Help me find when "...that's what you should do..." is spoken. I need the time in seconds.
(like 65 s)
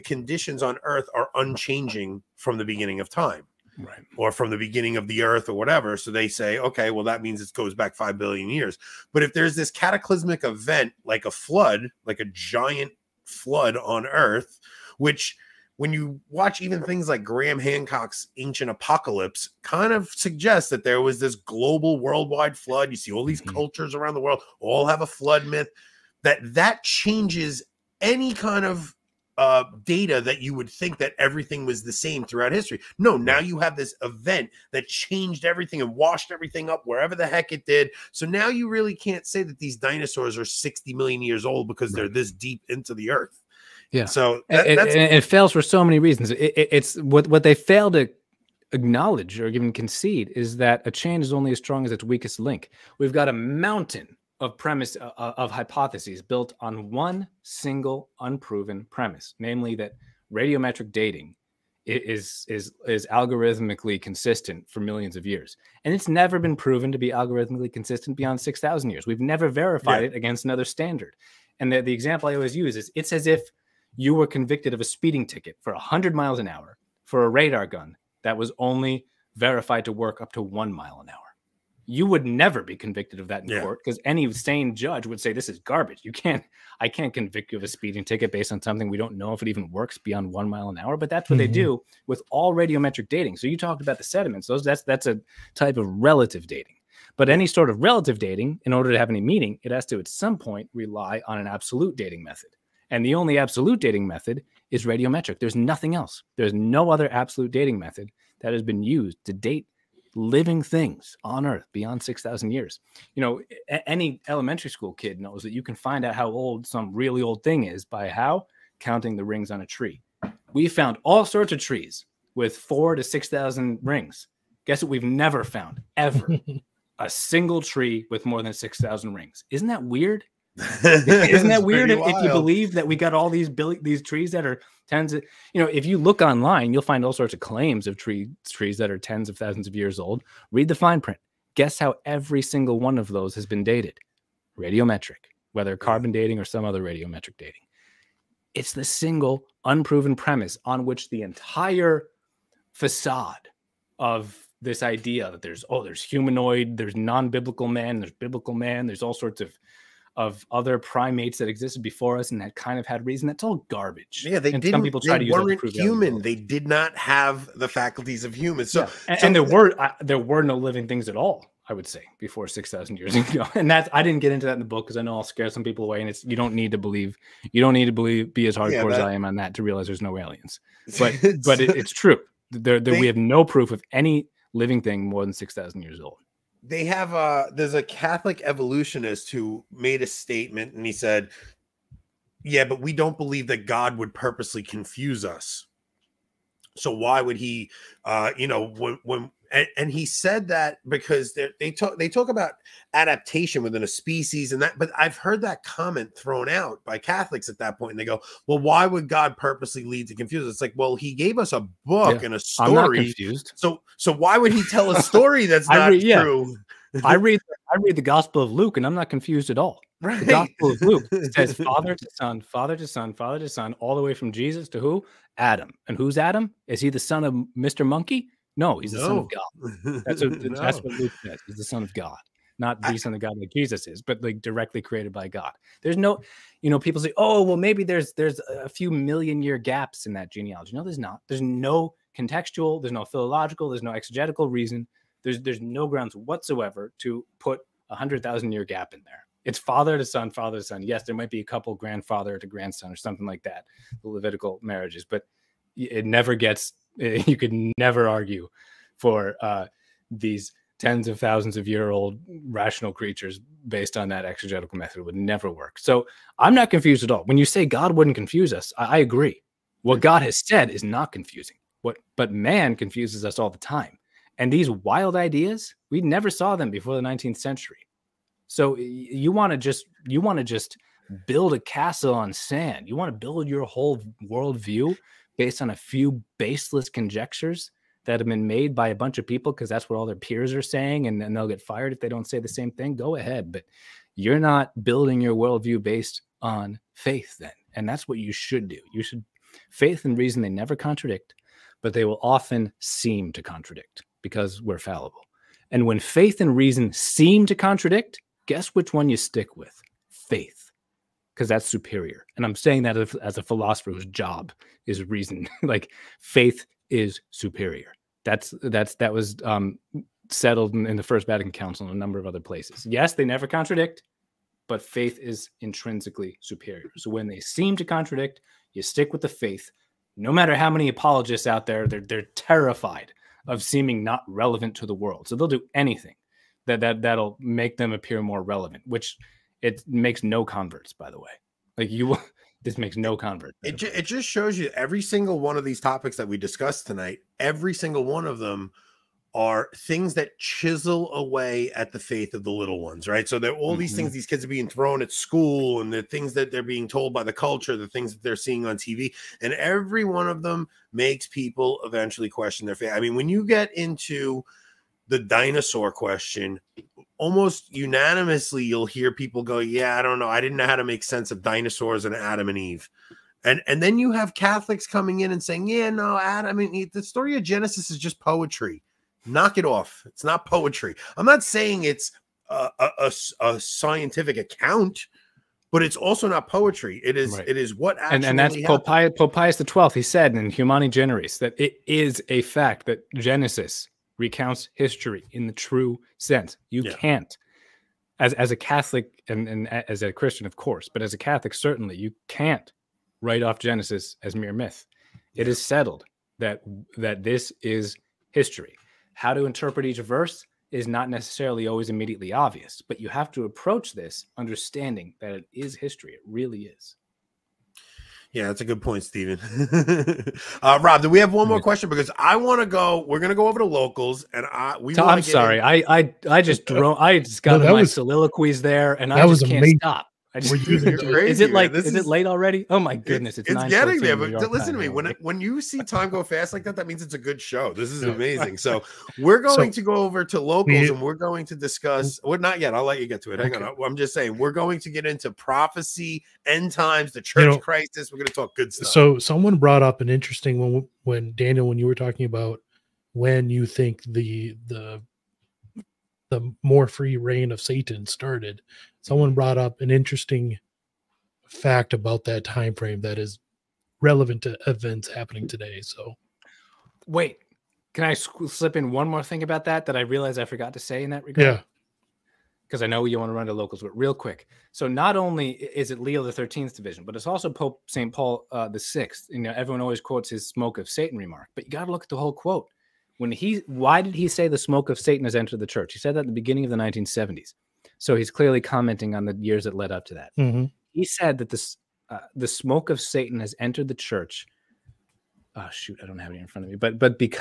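297 s.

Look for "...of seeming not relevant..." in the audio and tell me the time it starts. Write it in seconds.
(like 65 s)
333 s.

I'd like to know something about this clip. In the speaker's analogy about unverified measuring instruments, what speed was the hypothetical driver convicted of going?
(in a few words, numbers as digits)
100 miles an hour.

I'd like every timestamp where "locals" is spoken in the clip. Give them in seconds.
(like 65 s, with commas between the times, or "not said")
423 s, 440 s, 473 s.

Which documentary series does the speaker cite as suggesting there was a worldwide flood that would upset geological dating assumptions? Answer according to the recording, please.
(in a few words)
Ancient Apocalypse.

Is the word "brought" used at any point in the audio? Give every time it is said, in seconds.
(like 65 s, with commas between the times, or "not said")
449 s, 459 s.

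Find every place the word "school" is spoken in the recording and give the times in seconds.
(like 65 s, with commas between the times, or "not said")
114 s, 355 s.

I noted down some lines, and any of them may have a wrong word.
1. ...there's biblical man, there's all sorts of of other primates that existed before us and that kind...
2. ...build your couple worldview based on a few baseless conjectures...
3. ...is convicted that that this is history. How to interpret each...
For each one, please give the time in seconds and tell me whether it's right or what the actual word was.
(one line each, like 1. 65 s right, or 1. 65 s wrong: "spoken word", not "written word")
1. 157 s right
2. 283 s wrong: "whole", not "couple"
3. 405 s wrong: "settled", not "convicted".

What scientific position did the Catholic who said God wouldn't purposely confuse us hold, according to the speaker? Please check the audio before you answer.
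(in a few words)
Evolutionist.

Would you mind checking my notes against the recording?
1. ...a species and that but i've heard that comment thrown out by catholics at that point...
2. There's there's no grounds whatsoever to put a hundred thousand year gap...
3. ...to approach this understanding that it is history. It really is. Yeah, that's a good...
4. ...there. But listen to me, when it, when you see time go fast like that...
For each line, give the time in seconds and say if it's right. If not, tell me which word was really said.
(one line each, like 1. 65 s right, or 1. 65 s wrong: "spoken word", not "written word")
1. 203 s right
2. 245 s right
3. 413 s right
4. 433 s right.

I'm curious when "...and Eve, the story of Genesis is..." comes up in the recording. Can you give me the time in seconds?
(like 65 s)
376 s.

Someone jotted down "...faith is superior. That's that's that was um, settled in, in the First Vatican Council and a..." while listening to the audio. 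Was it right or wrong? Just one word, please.
right.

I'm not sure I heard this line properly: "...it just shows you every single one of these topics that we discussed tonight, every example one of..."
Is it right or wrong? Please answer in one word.
wrong.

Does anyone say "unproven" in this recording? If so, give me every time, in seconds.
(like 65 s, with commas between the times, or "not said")
58 s, 149 s.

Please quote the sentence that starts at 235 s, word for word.
There's no, you know, people say, oh, well, maybe there's there's a few million year gaps in that genealogy.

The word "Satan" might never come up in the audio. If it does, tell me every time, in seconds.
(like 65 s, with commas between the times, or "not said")
457 s, 480 s, 484 s, 492 s.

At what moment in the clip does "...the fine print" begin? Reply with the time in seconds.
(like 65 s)
140 s.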